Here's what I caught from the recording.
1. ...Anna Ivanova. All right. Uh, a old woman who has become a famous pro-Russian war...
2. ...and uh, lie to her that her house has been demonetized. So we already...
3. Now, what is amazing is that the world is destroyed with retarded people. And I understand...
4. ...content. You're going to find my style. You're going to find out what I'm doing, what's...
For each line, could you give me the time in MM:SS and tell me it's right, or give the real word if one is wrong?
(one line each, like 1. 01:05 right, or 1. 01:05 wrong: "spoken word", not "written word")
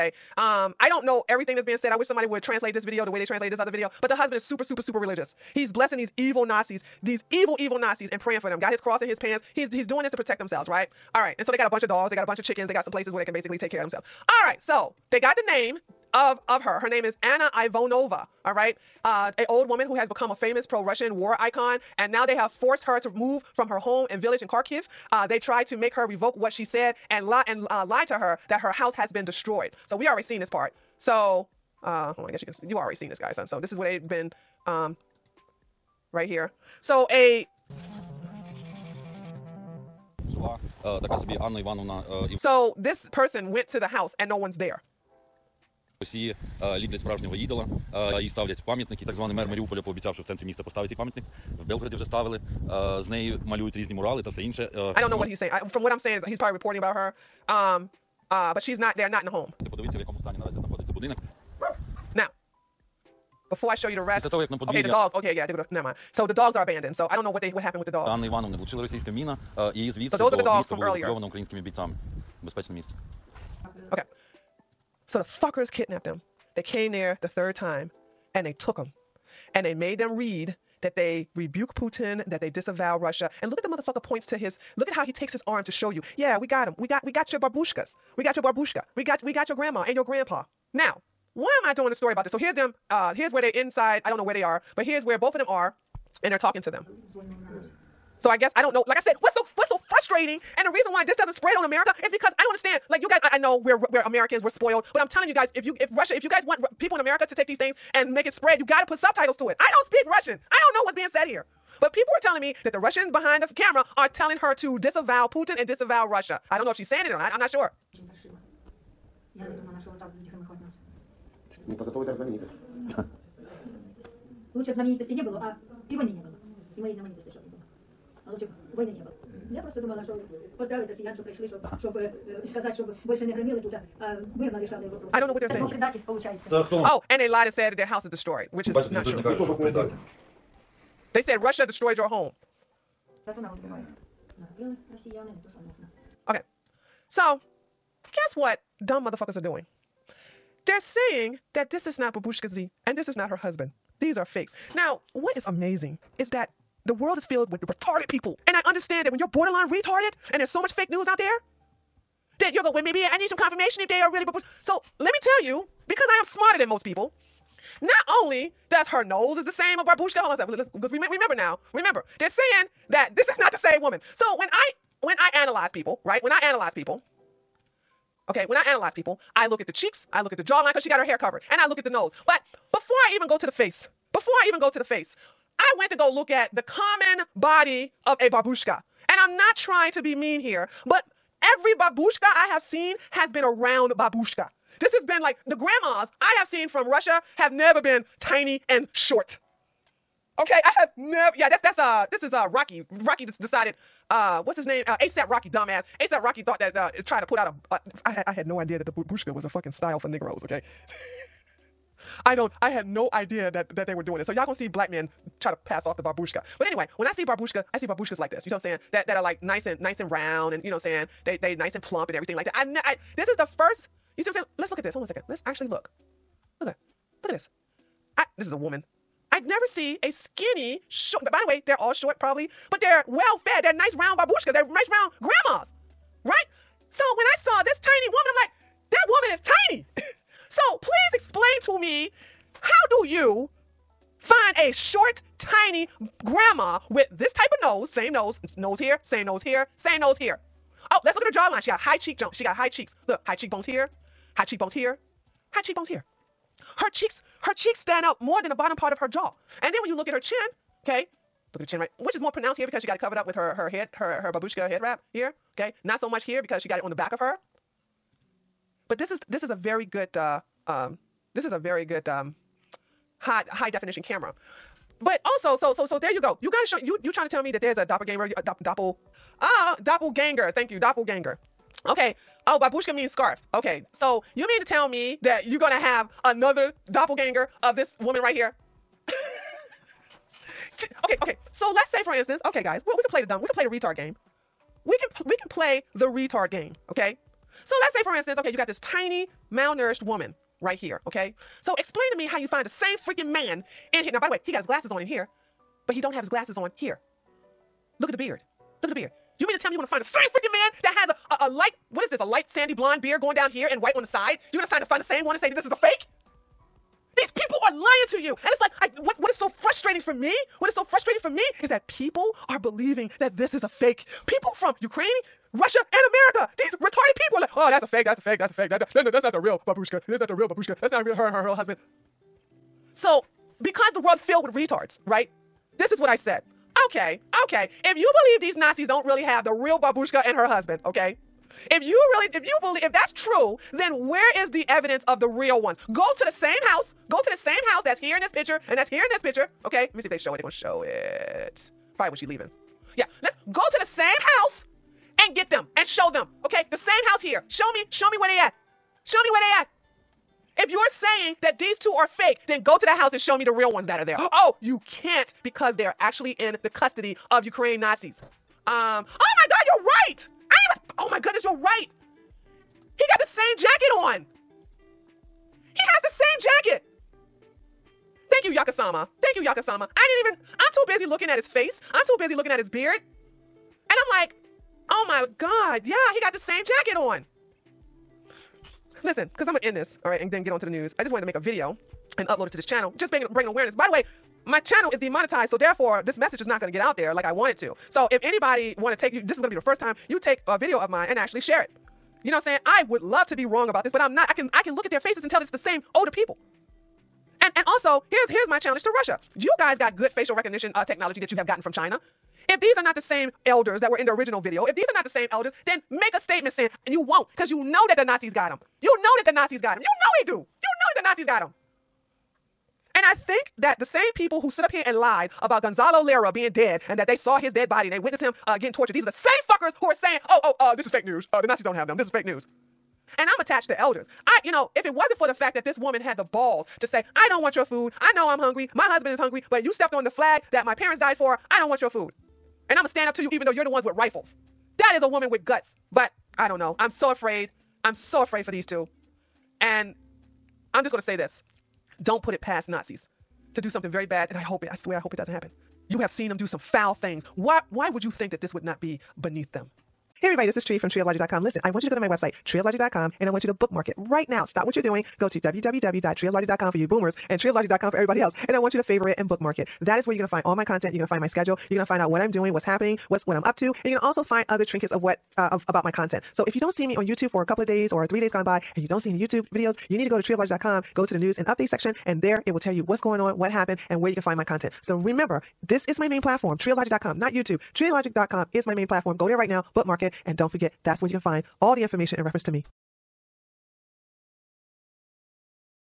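1. 00:17 right
2. 00:27 wrong: "destroyed", not "demonetized"
3. 02:34 wrong: "filled", not "destroyed"
4. 07:50 wrong: "schedule", not "style".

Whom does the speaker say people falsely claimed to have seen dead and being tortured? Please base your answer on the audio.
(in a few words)
Gonzalo Lira.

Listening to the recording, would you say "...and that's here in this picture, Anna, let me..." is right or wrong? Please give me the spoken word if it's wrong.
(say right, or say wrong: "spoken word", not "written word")
wrong: "Okay", not "Anna".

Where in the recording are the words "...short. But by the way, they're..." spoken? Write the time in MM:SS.
03:50.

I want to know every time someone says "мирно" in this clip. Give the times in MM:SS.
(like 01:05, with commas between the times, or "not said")
02:14.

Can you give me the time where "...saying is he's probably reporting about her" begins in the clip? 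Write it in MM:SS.
00:55.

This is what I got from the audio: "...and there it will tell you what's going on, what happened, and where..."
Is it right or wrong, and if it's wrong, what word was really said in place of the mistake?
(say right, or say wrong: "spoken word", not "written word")
right.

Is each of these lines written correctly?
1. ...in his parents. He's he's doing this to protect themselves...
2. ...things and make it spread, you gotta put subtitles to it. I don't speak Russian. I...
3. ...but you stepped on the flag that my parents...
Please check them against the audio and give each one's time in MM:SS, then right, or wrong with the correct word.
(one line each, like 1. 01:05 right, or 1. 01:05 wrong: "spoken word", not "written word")
1. 00:09 wrong: "pants", not "parents"
2. 01:47 right
3. 07:19 right.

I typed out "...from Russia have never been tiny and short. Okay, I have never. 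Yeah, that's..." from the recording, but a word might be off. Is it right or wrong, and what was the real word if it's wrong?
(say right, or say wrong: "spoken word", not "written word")
right.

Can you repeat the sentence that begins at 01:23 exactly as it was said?
And look at the motherfucker points to his look at how he takes his arm to show you.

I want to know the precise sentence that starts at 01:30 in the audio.
Now, why am I doing a story about this?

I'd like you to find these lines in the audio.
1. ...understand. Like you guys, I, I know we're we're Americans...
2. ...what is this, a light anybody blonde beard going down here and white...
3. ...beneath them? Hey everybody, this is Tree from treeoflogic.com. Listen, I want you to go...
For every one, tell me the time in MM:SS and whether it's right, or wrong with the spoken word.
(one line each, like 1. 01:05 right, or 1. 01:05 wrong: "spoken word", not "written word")
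1. 01:42 right
2. 05:11 wrong: "sandy", not "anybody"
3. 07:39 right.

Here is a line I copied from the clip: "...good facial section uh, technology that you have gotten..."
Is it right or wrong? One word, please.
wrong.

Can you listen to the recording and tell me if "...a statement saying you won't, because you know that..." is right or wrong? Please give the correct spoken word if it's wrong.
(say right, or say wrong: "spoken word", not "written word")
right.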